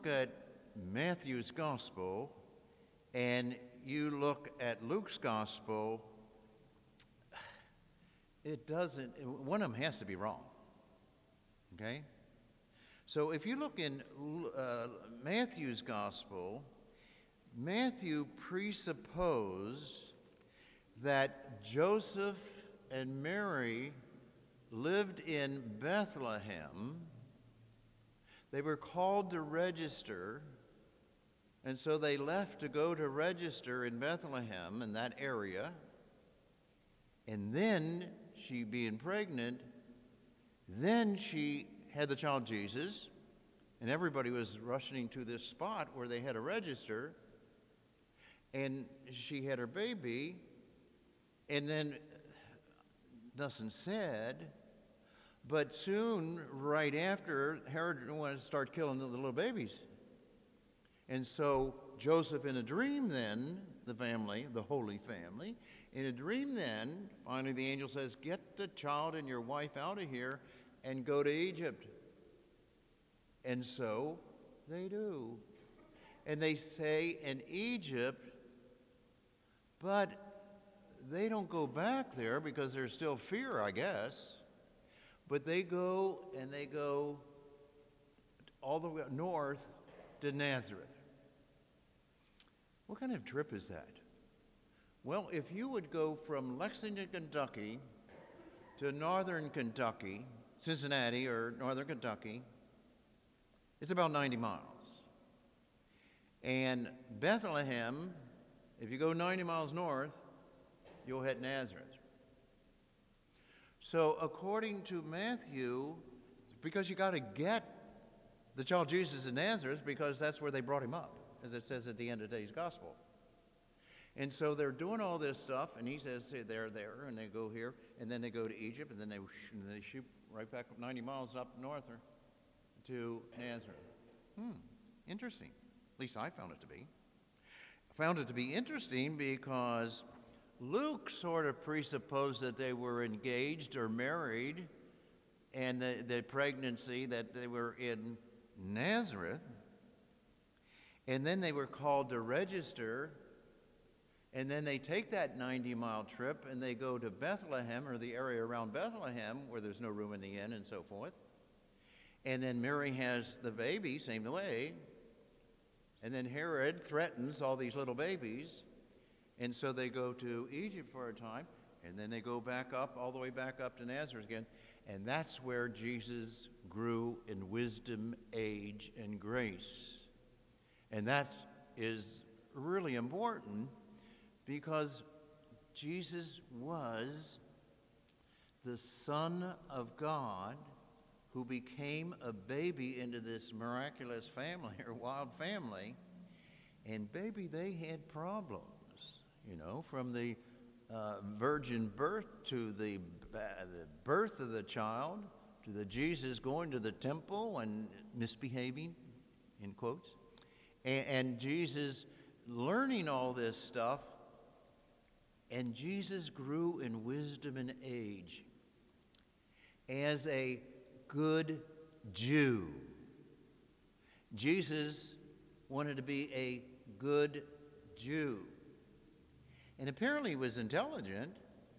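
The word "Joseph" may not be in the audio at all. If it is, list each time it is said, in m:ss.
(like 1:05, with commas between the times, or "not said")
0:21, 1:01.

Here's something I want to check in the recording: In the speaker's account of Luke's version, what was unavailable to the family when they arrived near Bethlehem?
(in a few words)
room in the inn.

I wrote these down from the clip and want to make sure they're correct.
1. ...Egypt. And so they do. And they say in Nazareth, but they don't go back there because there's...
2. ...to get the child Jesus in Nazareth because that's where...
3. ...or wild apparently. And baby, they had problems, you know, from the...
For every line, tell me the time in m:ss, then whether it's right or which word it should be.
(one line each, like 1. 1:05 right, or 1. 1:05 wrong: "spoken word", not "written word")
1. 1:11 wrong: "Egypt", not "Nazareth"
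2. 1:57 right
3. 3:14 wrong: "family", not "apparently".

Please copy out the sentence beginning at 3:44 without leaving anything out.
Jesus wanted to be a good Jew.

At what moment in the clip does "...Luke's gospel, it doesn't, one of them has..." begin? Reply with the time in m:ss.
0:04.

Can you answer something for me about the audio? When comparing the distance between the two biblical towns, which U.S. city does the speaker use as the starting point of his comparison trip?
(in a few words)
Lexington, Kentucky.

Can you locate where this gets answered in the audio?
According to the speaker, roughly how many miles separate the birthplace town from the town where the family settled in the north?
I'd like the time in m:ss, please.
1:43.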